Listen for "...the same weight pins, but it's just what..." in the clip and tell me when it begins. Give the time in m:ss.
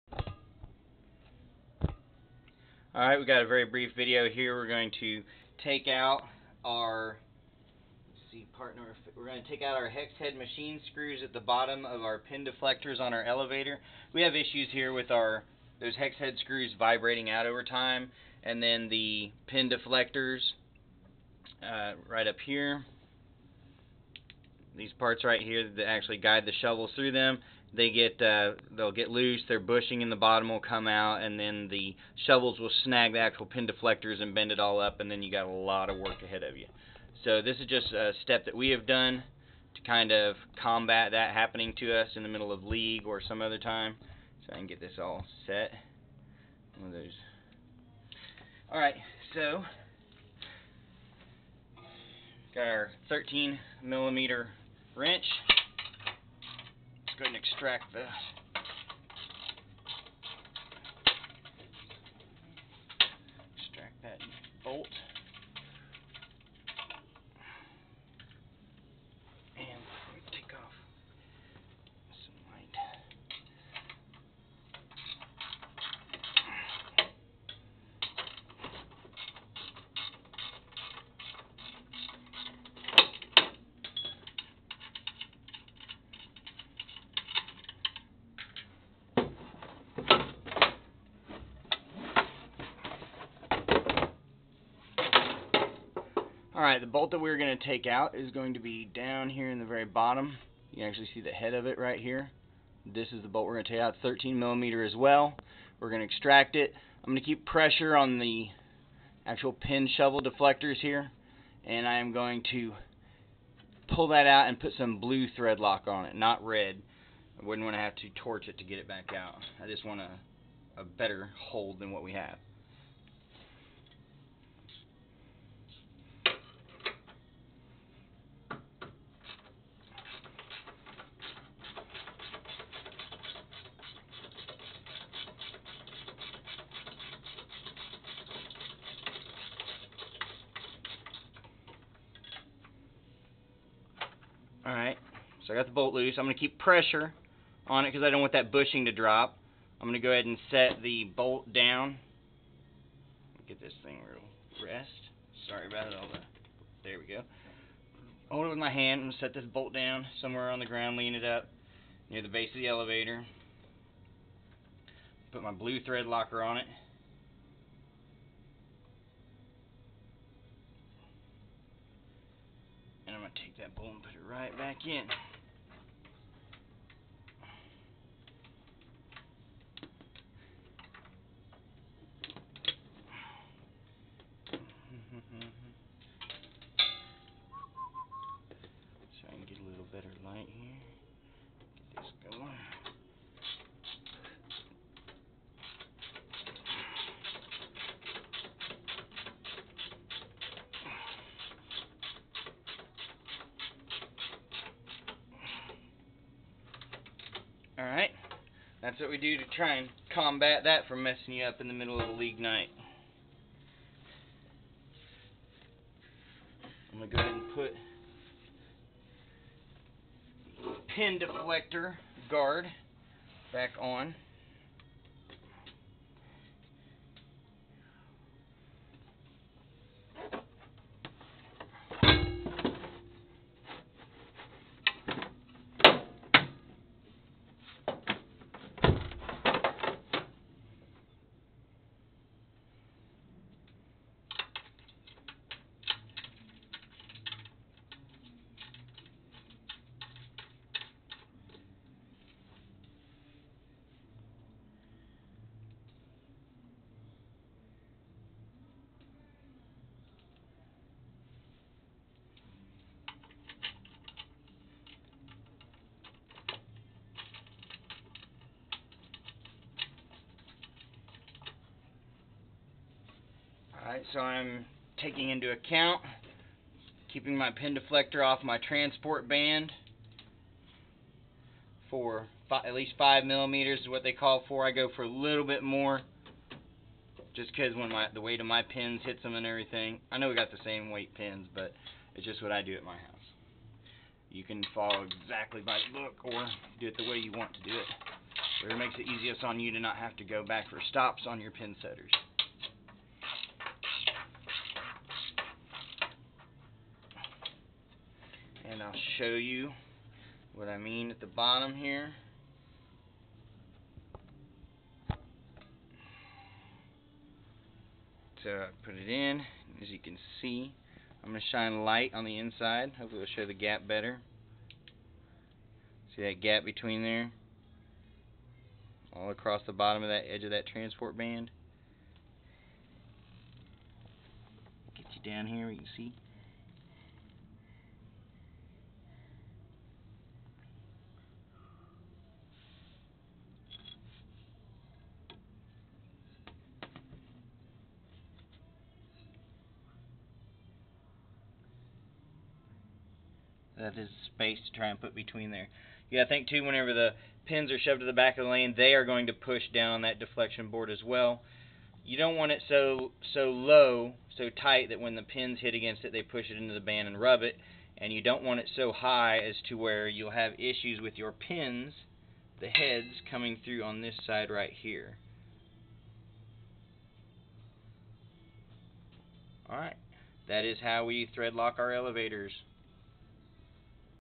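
4:50.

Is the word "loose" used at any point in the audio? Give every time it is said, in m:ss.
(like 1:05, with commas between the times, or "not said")
0:29, 2:25.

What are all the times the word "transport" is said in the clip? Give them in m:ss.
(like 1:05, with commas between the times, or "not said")
4:38, 5:30.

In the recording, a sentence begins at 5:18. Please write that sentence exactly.
So I put it in, as you can see, I'm going to shine light on the inside.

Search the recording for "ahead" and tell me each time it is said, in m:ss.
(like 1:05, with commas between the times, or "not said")
0:36, 0:57, 2:30, 3:37.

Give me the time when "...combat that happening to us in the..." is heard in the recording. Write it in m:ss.
0:40.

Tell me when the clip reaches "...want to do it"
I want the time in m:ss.
4:57.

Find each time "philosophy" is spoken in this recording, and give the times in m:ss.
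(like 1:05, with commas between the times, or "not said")
not said.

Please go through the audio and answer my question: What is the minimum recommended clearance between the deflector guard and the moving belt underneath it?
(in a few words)
5 millimeters.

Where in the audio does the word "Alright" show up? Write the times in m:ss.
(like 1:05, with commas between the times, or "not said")
0:02, 1:36, 2:24, 3:27, 4:33, 6:19.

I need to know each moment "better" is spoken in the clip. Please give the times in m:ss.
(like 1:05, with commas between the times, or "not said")
2:00, 5:23.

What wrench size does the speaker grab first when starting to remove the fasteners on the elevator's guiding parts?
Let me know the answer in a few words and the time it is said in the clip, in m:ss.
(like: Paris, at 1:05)
13 millimeter, at 0:53.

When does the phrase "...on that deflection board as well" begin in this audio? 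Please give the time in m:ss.
5:59.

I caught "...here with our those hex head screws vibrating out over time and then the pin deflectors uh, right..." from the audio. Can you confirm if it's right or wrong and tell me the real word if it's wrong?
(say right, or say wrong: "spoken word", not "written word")
right.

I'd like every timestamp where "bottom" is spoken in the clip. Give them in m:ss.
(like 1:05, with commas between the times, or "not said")
0:11, 0:30, 1:39, 5:11, 5:29.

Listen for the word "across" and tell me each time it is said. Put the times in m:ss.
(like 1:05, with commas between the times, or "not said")
5:29.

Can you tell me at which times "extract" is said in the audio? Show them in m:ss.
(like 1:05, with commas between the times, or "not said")
0:57, 1:46.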